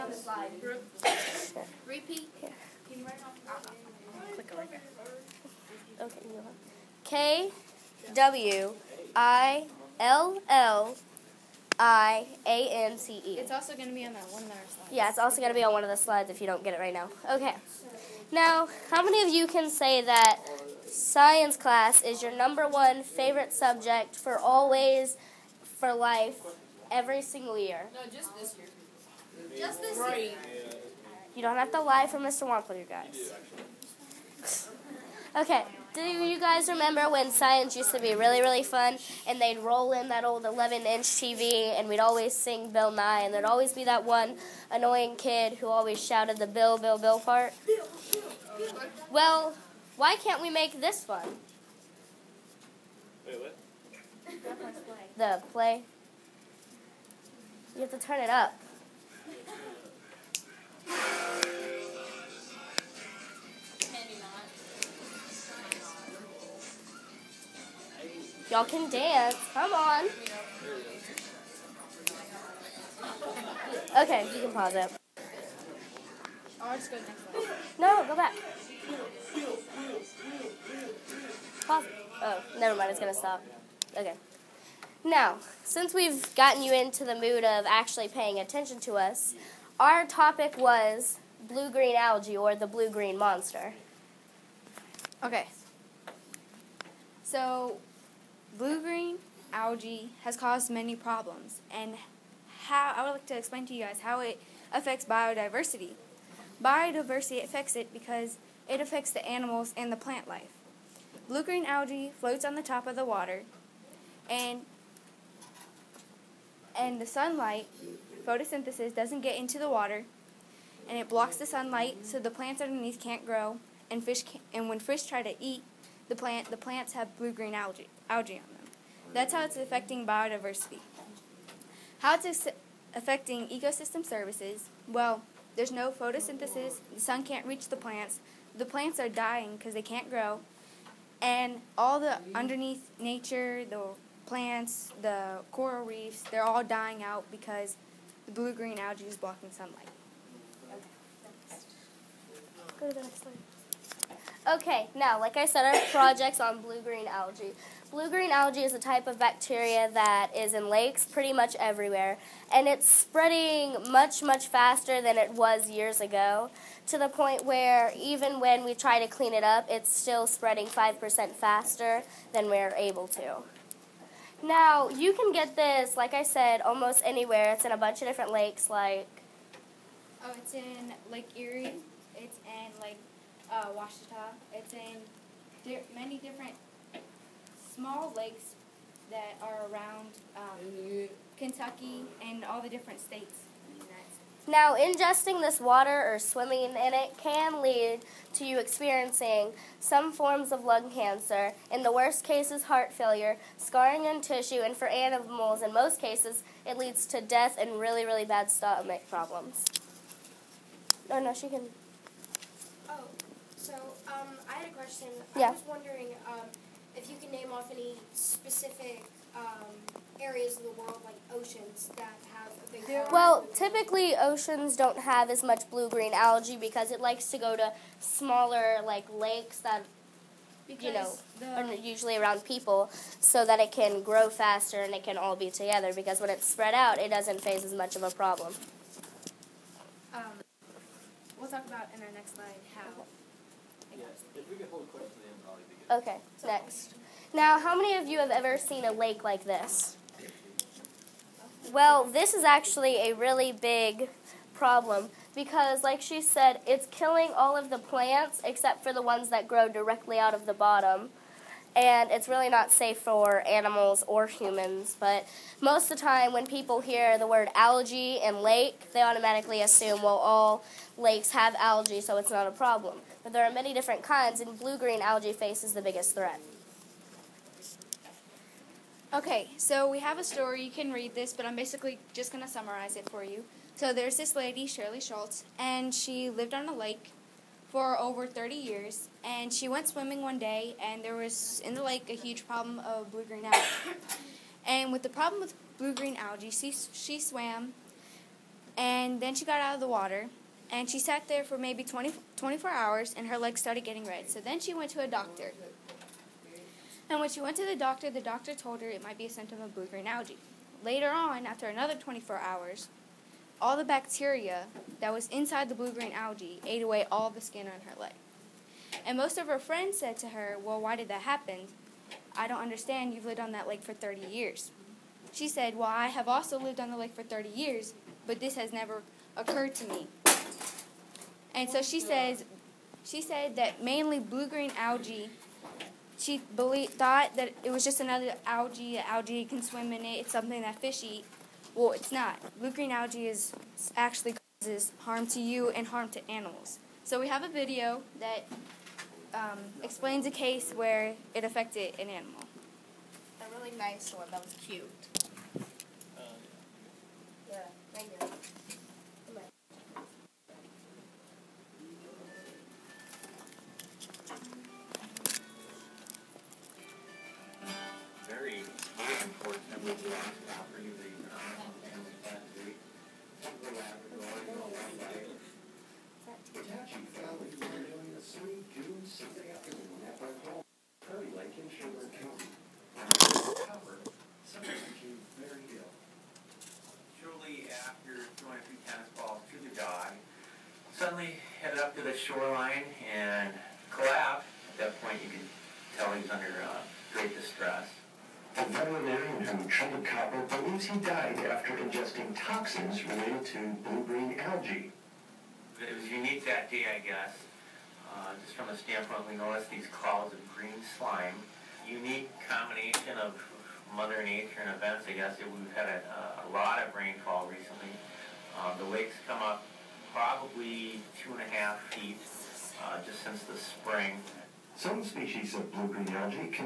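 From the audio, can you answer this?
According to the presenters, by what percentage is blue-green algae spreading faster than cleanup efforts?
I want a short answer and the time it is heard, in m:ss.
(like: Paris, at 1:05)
5%, at 2:50.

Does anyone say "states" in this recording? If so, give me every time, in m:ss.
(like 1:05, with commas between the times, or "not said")
3:13.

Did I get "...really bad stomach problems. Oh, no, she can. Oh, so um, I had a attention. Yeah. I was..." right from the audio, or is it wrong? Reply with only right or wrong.
wrong.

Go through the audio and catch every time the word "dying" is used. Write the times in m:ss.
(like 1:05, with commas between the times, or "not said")
2:19, 2:26.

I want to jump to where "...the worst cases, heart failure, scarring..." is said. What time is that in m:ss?
3:21.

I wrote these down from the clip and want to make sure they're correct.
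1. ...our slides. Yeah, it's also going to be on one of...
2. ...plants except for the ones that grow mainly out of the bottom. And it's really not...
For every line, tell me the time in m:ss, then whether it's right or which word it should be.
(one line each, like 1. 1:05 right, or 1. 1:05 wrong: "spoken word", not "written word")
1. 0:14 right
2. 4:17 wrong: "directly", not "mainly".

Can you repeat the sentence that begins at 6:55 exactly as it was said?
We've had a, a lot of rainfall recently.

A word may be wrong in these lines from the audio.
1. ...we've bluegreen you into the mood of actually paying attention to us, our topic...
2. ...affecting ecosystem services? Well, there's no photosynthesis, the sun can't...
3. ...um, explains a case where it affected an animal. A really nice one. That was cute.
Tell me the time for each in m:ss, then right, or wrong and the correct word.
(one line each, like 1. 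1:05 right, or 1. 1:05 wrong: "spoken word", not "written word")
1. 1:25 wrong: "gotten", not "bluegreen"
2. 2:12 right
3. 5:49 right.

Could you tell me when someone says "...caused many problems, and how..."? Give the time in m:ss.
1:40.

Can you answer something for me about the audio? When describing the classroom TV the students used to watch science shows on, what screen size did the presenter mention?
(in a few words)
11 inch.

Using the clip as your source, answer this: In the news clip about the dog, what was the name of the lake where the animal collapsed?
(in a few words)
Prairie Lake.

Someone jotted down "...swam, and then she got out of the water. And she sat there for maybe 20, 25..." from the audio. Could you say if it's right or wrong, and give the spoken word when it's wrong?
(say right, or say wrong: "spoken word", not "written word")
wrong: "24", not "25".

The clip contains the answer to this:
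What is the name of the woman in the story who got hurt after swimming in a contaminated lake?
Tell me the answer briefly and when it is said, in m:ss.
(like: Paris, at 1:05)
Shirley Schultz, at 4:44.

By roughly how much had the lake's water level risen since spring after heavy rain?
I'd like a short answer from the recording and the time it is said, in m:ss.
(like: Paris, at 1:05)
2.5 feet, at 7:01.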